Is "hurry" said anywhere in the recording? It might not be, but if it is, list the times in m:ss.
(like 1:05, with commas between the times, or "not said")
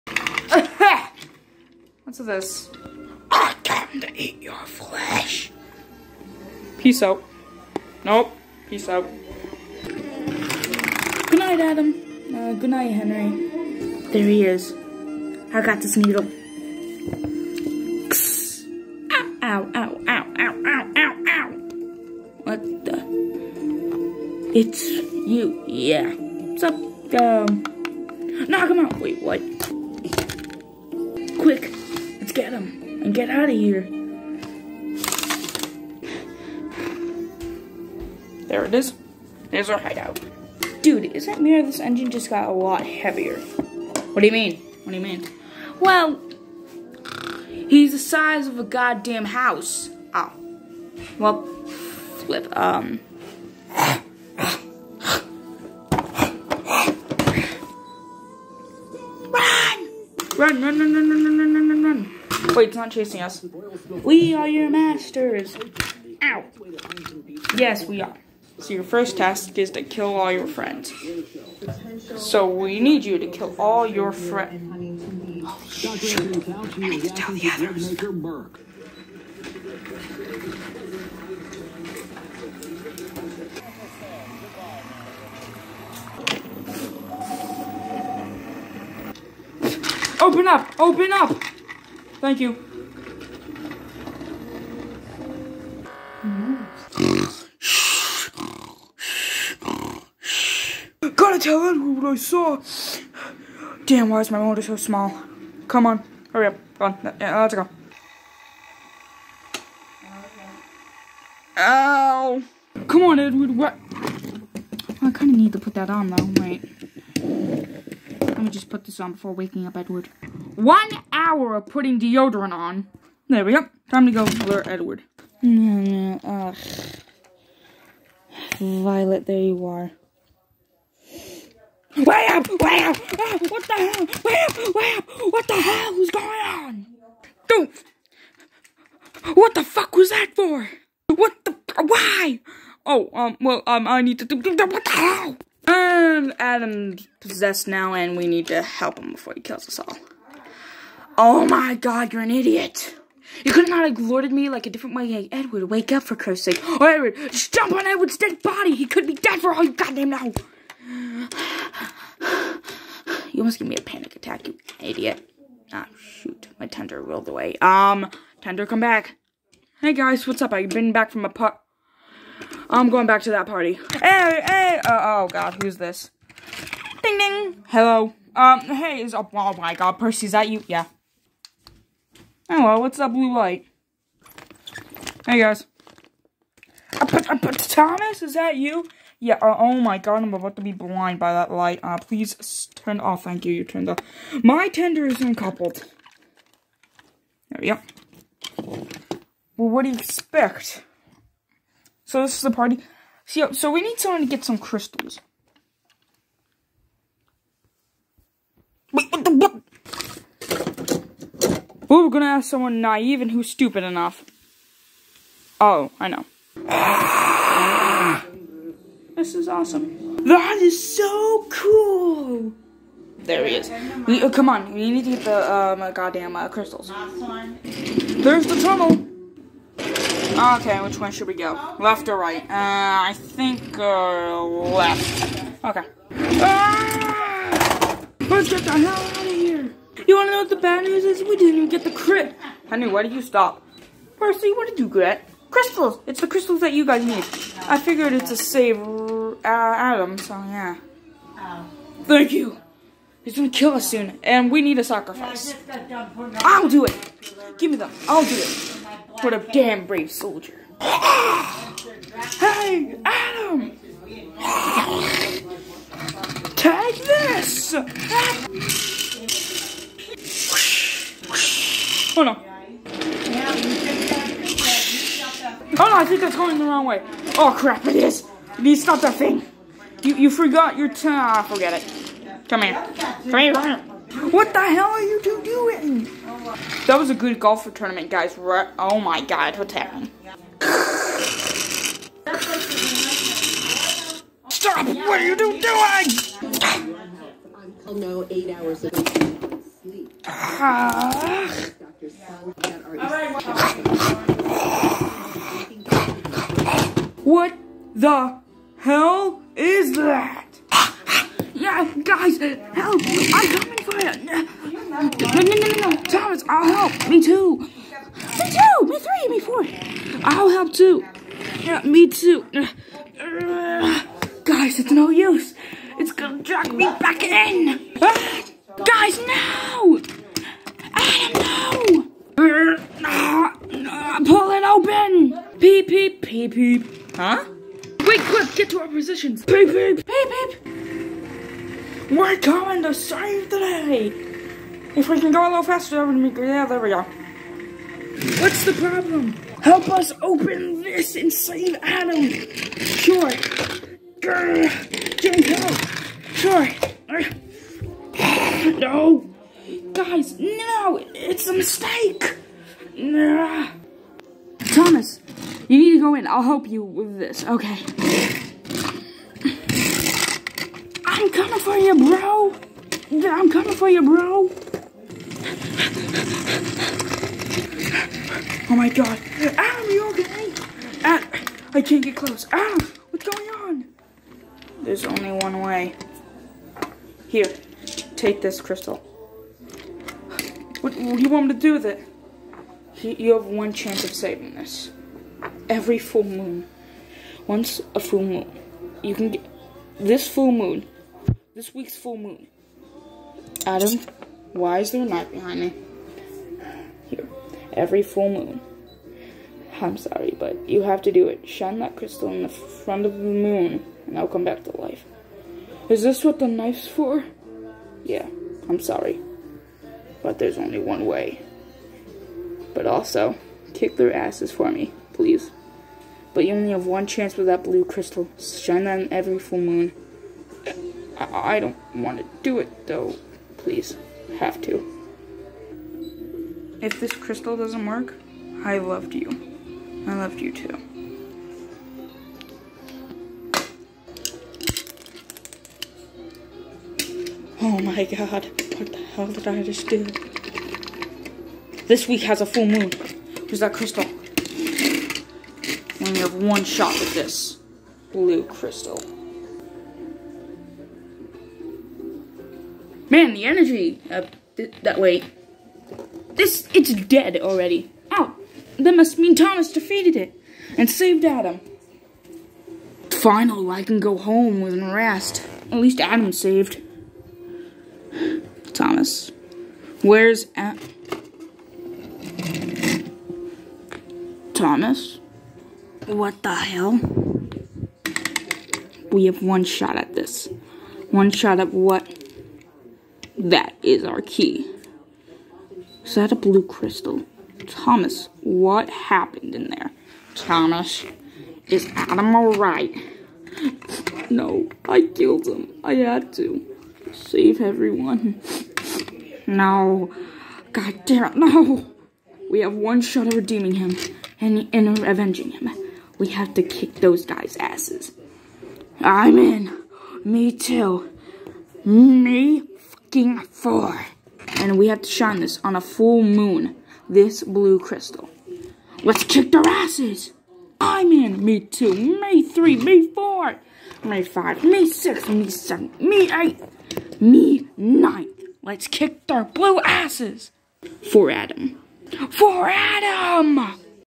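1:46.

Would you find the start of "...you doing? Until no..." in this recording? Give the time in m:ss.
4:55.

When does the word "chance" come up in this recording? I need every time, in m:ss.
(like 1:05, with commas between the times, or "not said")
6:33, 7:07.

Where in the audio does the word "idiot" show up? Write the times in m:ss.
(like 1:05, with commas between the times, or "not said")
2:32, 2:44.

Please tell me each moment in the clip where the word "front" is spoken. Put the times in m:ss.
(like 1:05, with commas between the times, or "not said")
6:52.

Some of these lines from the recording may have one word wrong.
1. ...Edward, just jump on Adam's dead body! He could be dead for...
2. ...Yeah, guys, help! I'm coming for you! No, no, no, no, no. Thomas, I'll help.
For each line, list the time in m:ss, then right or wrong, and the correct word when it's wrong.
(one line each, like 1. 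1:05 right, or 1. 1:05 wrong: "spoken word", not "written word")
1. 2:36 wrong: "Edward", not "Adam"
2. 5:11 right.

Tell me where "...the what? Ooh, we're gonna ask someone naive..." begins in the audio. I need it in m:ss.
3:29.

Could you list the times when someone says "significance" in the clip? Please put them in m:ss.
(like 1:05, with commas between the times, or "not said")
not said.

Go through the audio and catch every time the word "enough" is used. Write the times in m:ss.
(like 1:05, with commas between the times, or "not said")
3:33.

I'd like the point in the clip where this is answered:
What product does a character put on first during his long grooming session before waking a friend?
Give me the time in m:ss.
2:01.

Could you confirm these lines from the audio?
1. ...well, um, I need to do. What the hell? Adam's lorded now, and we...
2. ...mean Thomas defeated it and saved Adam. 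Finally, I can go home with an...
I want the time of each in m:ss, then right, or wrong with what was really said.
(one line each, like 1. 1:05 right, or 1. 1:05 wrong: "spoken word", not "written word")
1. 2:23 wrong: "possessed", not "lorded"
2. 7:49 right.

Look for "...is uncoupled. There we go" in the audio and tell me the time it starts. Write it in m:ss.
3:15.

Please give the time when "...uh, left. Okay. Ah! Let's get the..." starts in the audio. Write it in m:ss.
3:53.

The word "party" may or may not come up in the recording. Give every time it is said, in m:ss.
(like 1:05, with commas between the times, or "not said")
2:53, 3:22.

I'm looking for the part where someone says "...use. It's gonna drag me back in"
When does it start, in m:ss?
5:25.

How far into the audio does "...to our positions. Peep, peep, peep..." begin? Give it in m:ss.
5:38.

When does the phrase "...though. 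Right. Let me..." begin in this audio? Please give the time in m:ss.
1:56.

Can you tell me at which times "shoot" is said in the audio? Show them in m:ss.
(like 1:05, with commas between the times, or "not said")
1:15, 2:45.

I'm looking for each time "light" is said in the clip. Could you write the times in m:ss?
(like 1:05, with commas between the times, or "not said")
3:03, 3:11.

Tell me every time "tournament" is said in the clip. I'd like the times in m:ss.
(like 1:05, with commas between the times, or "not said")
4:47.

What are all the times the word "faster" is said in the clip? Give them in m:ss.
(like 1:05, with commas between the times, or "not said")
5:45.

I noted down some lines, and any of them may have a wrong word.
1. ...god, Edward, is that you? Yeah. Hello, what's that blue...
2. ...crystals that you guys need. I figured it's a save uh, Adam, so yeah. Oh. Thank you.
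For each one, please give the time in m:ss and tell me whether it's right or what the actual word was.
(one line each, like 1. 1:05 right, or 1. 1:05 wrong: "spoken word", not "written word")
1. 2:59 wrong: "Percy", not "Edward"
2. 4:06 right.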